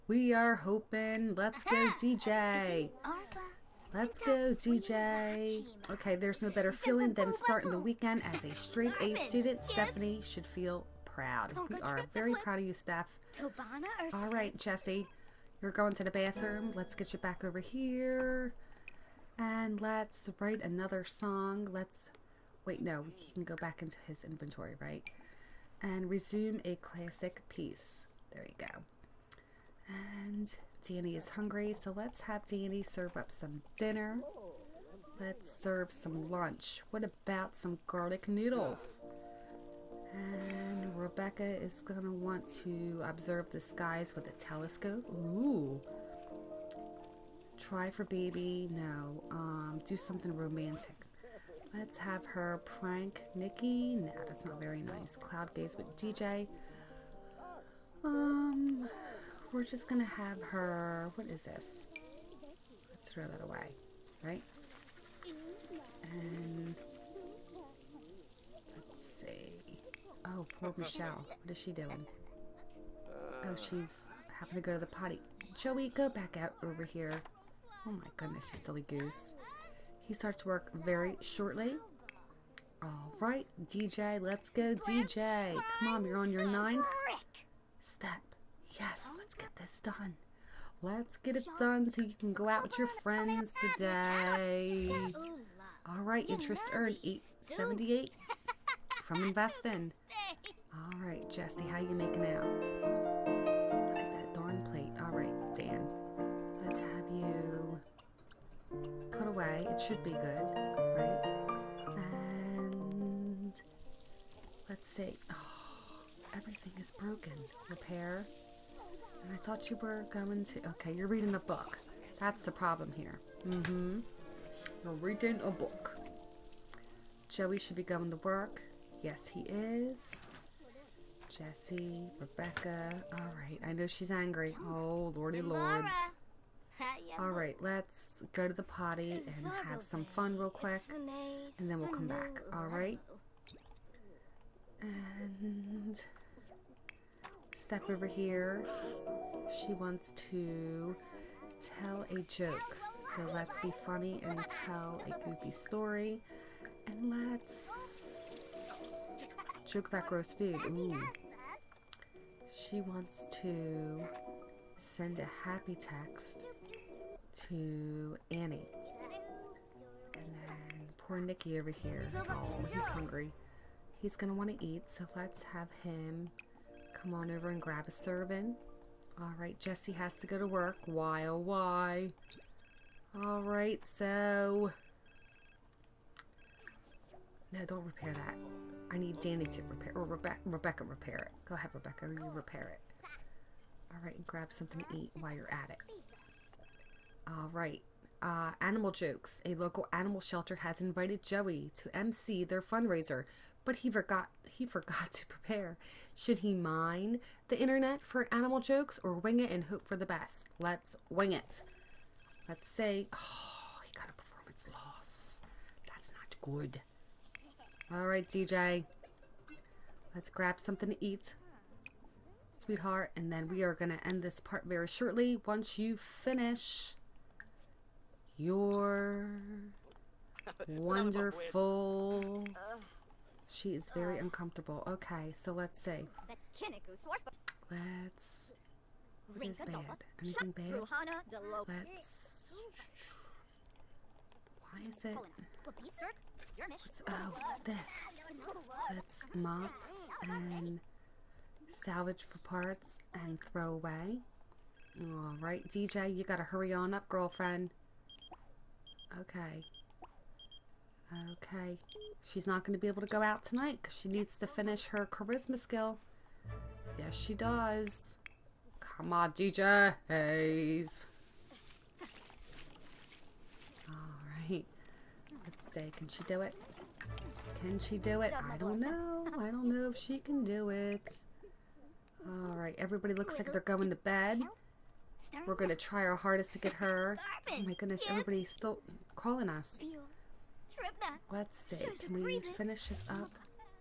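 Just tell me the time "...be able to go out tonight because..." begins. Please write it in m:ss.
4:22.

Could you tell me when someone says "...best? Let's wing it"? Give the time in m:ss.
3:30.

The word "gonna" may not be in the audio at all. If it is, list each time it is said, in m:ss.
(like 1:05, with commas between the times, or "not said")
0:59, 4:45.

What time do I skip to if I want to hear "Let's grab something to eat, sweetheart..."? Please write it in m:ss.
3:40.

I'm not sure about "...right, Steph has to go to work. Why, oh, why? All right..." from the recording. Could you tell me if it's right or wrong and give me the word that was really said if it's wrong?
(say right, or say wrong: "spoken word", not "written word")
wrong: "Jesse", not "Steph".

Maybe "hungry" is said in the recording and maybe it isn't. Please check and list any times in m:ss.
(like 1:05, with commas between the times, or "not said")
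0:31, 2:52.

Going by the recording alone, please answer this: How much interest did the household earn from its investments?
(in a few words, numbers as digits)
878.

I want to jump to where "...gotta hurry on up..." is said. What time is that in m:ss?
4:16.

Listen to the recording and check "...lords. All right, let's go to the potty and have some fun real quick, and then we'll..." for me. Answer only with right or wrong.
right.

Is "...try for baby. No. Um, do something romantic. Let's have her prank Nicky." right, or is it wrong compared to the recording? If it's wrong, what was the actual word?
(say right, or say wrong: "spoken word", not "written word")
right.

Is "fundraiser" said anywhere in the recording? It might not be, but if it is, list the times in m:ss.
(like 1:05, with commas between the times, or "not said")
3:22.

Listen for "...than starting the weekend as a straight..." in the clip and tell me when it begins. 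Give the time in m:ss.
0:07.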